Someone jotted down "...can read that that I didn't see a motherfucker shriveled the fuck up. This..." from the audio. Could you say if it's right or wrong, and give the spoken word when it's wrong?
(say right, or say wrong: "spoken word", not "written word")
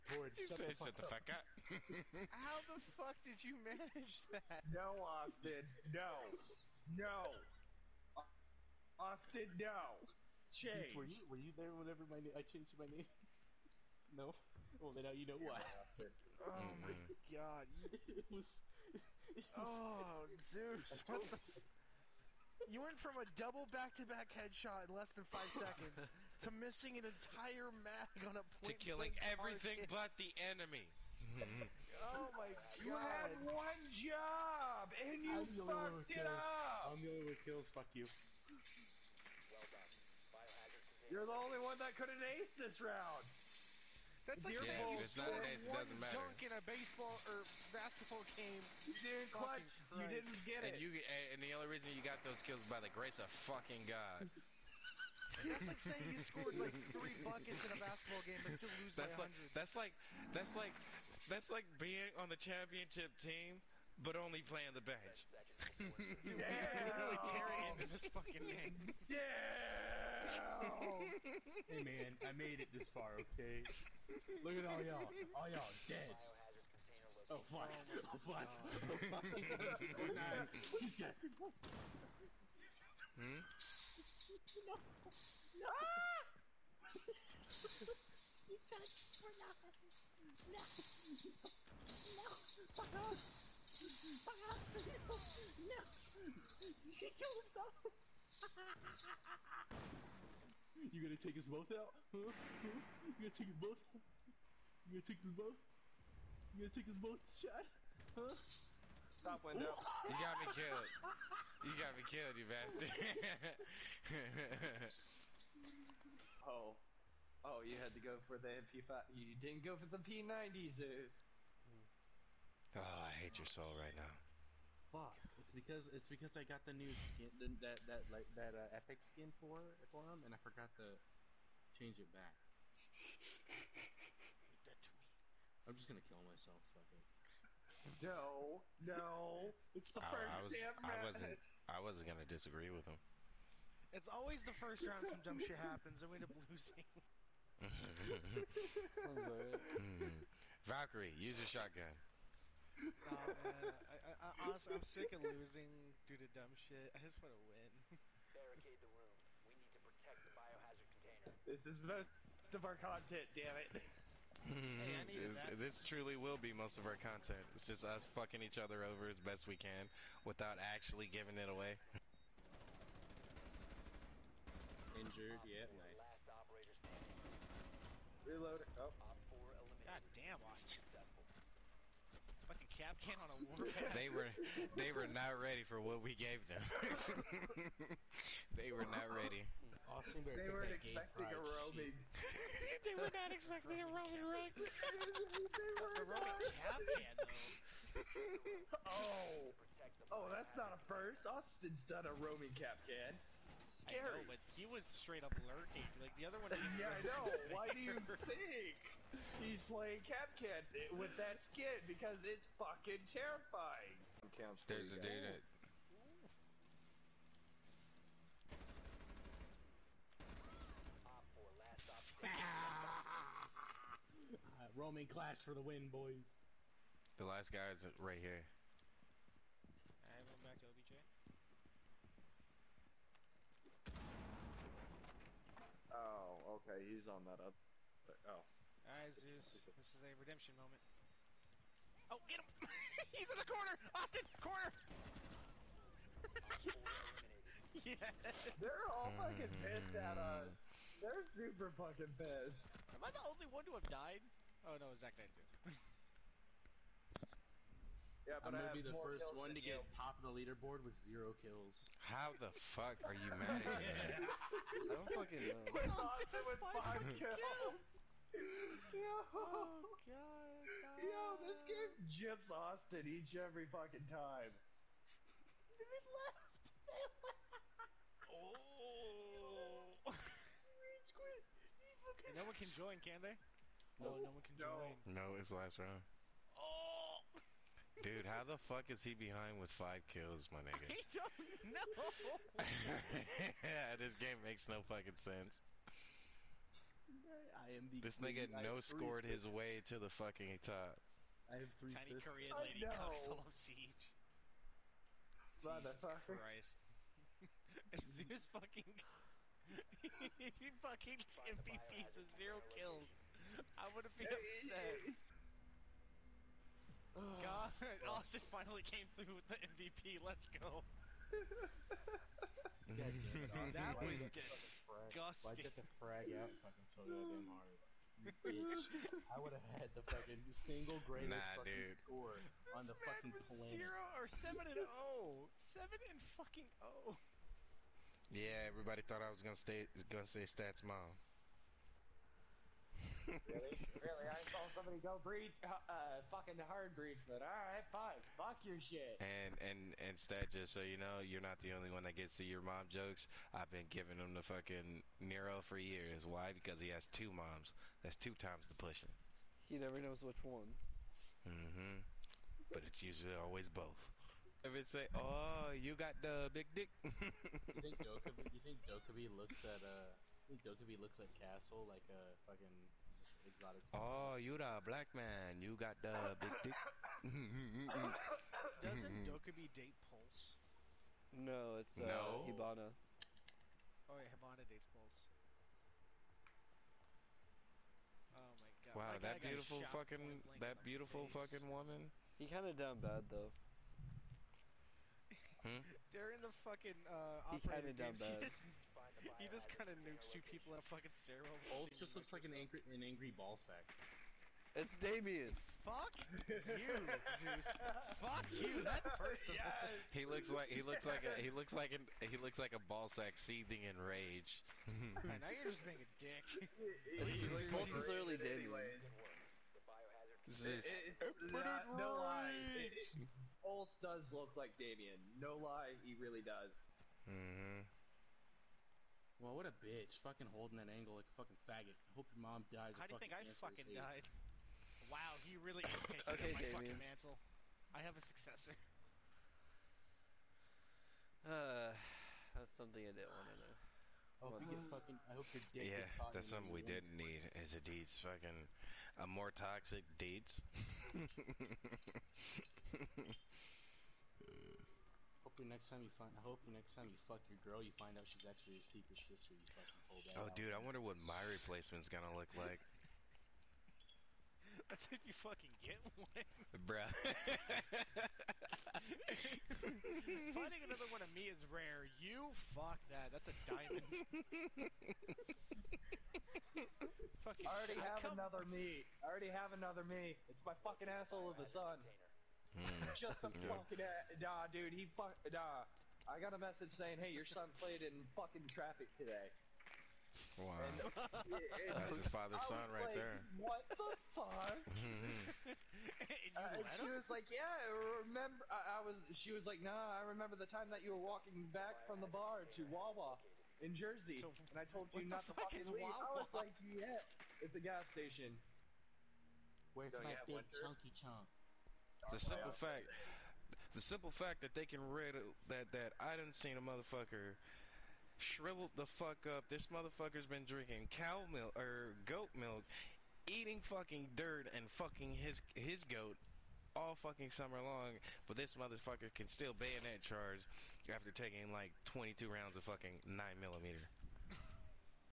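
right.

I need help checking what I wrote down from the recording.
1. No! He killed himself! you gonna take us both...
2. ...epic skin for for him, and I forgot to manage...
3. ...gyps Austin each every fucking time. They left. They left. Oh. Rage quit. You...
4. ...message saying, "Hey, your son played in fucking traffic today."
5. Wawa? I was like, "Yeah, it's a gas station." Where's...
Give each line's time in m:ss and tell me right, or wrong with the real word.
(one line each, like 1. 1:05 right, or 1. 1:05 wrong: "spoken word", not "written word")
1. 1:35 right
2. 2:08 wrong: "change", not "manage"
3. 4:32 right
4. 8:06 right
5. 8:26 right.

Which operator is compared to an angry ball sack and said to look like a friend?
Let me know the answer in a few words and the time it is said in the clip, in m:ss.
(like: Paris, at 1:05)
Bolts, at 6:41.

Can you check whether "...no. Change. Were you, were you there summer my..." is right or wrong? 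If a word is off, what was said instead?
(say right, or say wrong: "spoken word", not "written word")
wrong: "whenever", not "summer".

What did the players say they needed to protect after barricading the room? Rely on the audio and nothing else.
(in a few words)
biohazard container.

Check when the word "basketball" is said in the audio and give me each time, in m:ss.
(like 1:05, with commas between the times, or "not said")
0:47, 0:57.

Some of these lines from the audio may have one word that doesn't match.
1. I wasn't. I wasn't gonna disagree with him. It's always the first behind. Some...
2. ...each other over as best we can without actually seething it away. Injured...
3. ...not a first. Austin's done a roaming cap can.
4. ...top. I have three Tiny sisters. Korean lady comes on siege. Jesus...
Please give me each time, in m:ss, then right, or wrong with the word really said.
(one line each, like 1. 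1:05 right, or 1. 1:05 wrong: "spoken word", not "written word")
1. 2:20 wrong: "round", not "behind"
2. 2:48 wrong: "giving", not "seething"
3. 3:20 right
4. 5:00 right.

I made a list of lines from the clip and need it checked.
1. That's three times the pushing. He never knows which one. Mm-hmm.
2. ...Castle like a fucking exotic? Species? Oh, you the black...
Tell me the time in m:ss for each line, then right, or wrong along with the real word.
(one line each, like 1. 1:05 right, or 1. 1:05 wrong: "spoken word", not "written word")
1. 5:58 wrong: "two", not "three"
2. 6:11 right.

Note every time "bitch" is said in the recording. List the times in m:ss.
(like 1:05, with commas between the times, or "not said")
5:28, 7:09.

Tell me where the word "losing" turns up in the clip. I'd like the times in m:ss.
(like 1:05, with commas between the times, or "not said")
2:26, 2:35.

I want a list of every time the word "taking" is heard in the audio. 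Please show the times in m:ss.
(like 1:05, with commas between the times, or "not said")
7:16, 8:51.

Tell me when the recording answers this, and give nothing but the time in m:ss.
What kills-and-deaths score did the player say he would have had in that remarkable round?
5:35.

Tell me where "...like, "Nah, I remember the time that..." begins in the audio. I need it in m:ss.
8:19.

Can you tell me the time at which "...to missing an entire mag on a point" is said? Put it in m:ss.
0:26.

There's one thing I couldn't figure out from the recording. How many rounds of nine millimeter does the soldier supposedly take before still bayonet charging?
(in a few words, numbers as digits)
22.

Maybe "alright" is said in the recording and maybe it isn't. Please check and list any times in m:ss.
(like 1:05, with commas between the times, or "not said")
3:50, 3:58, 5:47.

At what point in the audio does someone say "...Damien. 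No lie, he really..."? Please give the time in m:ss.
7:04.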